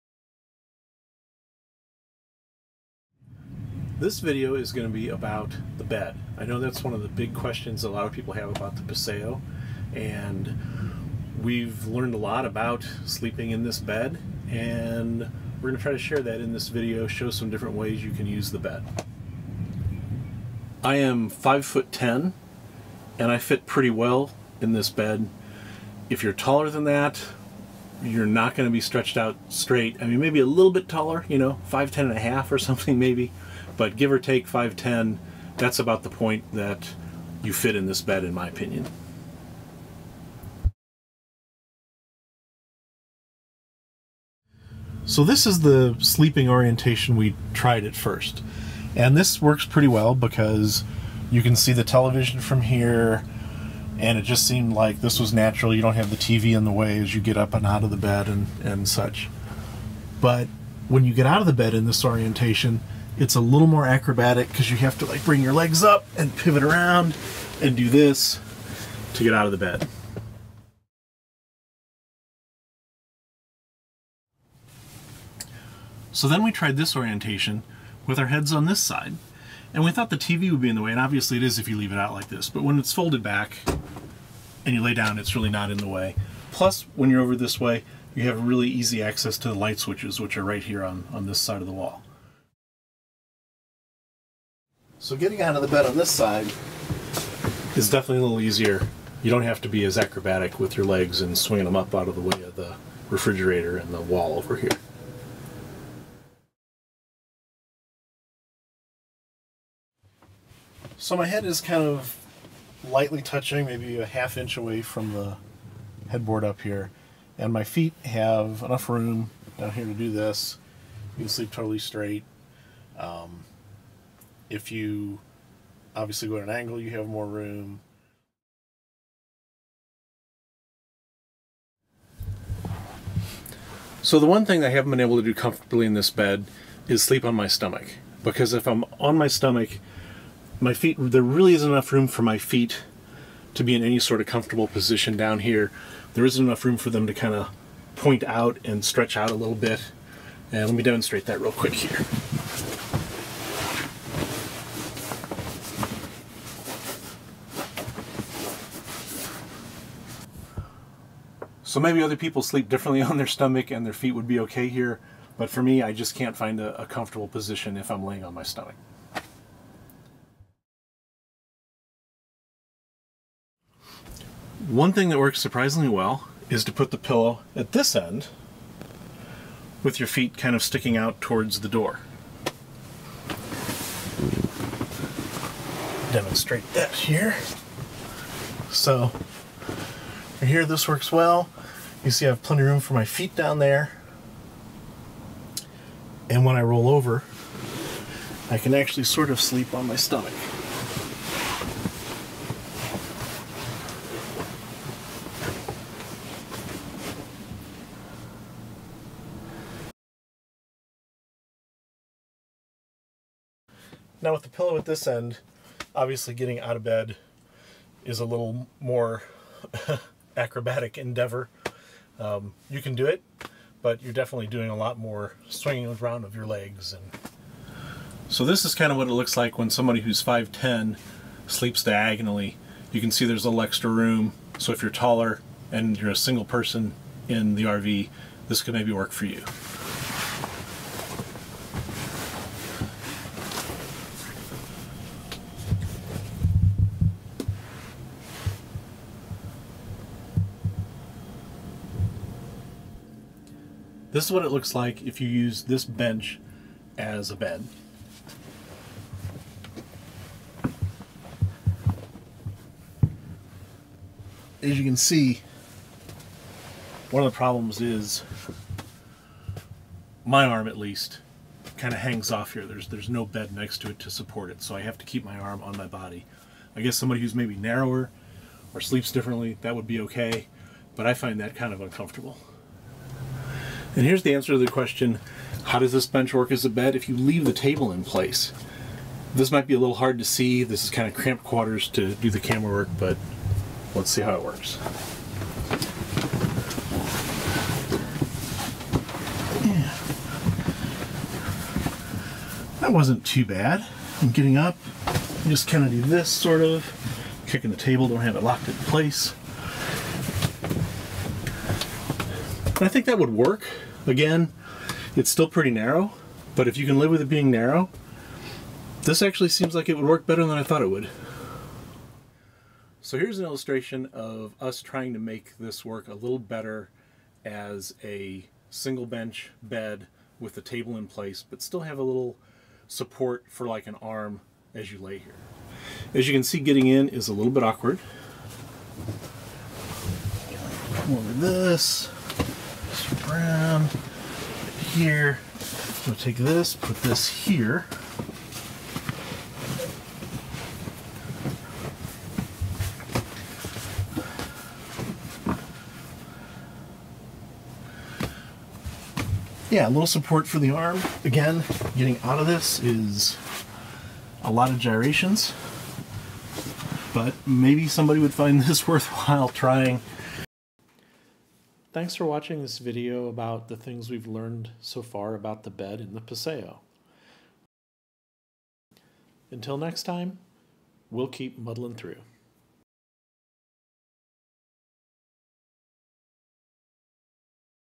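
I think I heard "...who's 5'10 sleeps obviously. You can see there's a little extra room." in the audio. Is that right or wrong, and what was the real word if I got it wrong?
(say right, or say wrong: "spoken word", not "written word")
wrong: "diagonally", not "obviously".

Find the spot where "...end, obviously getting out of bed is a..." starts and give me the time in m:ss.
3:35.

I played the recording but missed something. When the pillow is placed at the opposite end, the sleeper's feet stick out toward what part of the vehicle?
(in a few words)
the door.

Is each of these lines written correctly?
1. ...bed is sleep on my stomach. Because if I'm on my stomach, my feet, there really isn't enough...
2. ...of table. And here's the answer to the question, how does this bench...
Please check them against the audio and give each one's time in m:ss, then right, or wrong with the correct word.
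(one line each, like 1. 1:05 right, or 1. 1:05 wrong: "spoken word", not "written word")
1. 2:16 right
2. 4:41 wrong: "uncomfortable", not "table".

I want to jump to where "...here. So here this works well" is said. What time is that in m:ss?
3:06.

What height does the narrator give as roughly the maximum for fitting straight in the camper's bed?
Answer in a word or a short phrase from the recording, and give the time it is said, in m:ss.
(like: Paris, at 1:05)
5 foot 10, at 0:21.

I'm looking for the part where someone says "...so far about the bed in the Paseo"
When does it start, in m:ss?
6:14.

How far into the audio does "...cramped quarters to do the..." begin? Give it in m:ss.
4:51.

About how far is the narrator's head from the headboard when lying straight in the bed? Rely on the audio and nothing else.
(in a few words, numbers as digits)
half inch.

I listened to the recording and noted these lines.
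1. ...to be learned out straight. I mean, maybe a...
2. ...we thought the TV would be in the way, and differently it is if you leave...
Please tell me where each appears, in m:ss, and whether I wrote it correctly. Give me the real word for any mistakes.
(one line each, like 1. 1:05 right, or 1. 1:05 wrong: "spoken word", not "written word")
1. 0:28 wrong: "stretched", not "learned"
2. 1:19 wrong: "obviously", not "differently".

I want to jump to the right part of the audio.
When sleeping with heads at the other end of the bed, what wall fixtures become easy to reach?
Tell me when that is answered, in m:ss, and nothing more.
1:29.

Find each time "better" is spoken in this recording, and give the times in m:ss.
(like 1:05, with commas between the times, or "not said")
5:20, 5:26.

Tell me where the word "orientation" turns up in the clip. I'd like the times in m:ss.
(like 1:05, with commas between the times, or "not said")
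0:46, 1:02, 1:16.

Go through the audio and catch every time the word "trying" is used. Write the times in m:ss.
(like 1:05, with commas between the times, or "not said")
5:24, 6:09.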